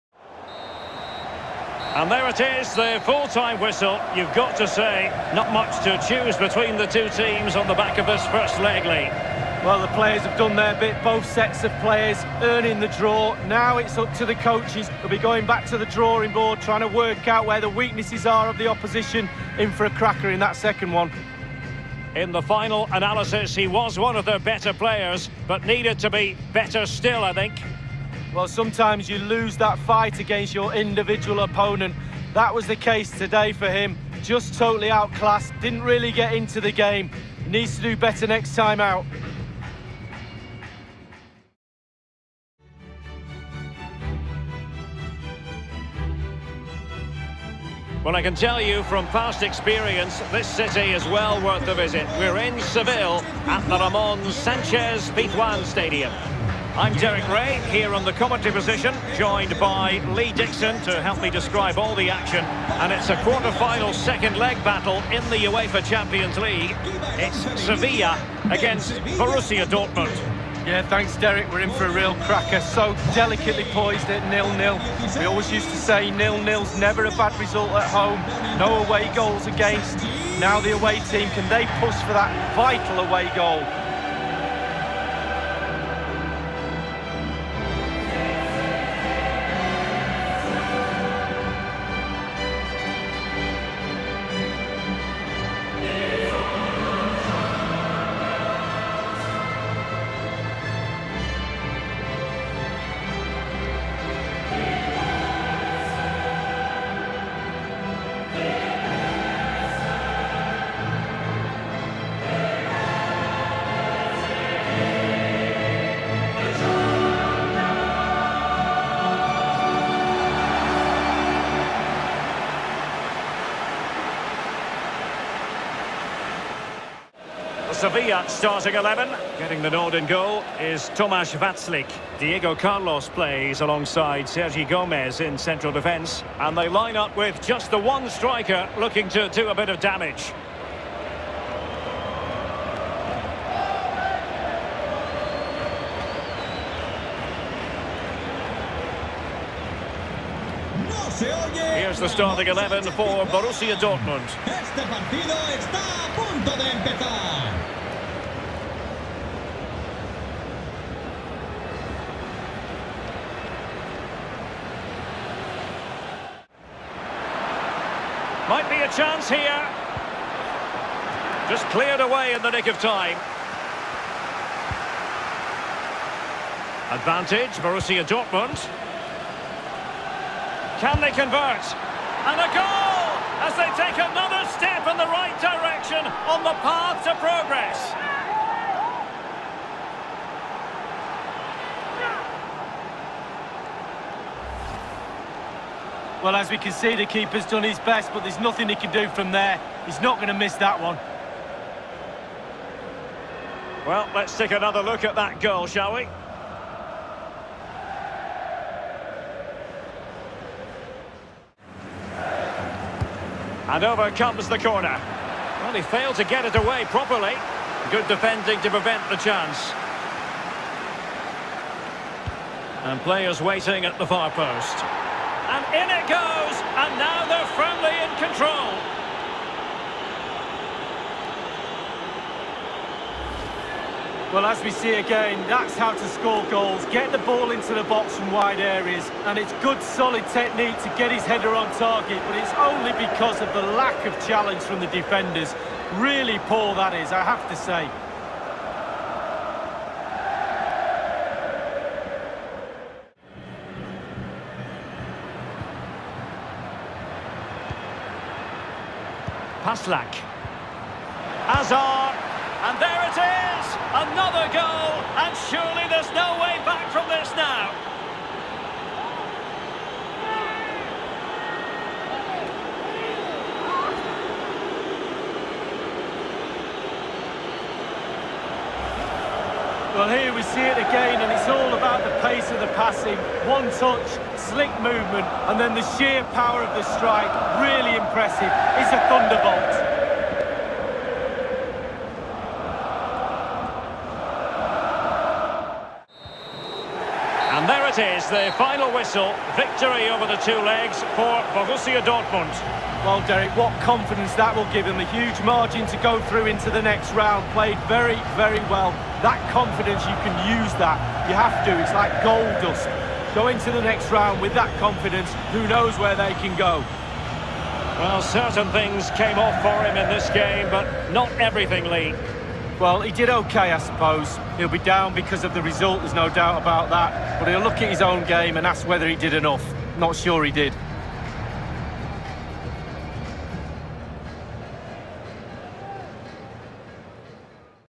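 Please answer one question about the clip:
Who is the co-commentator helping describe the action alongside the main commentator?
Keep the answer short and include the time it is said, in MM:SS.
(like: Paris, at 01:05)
Lee Dixon, at 01:00.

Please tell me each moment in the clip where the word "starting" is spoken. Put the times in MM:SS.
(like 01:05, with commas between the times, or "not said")
02:08, 02:32.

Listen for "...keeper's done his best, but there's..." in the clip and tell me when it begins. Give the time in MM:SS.
03:17.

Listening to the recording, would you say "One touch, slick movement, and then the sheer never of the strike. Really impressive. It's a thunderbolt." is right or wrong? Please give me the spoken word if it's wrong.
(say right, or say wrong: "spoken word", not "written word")
wrong: "power", not "never".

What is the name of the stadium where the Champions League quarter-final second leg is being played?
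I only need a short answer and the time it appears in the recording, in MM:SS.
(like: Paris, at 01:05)
Ramon Sanchez Pizjuan Stadium, at 00:53.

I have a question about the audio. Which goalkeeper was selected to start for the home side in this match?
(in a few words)
Tomáš Vaclík.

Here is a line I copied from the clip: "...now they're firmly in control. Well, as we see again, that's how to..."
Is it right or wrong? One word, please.
right.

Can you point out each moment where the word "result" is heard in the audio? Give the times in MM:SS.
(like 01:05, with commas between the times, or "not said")
01:17, 05:25.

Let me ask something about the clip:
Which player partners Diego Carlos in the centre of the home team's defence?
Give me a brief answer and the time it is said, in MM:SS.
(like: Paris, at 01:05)
Sergi Gomez, at 02:14.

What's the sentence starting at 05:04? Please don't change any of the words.
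A huge margin to go through into the next round.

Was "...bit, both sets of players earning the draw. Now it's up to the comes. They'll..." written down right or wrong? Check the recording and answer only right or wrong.
wrong.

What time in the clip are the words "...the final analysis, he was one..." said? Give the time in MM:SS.
00:22.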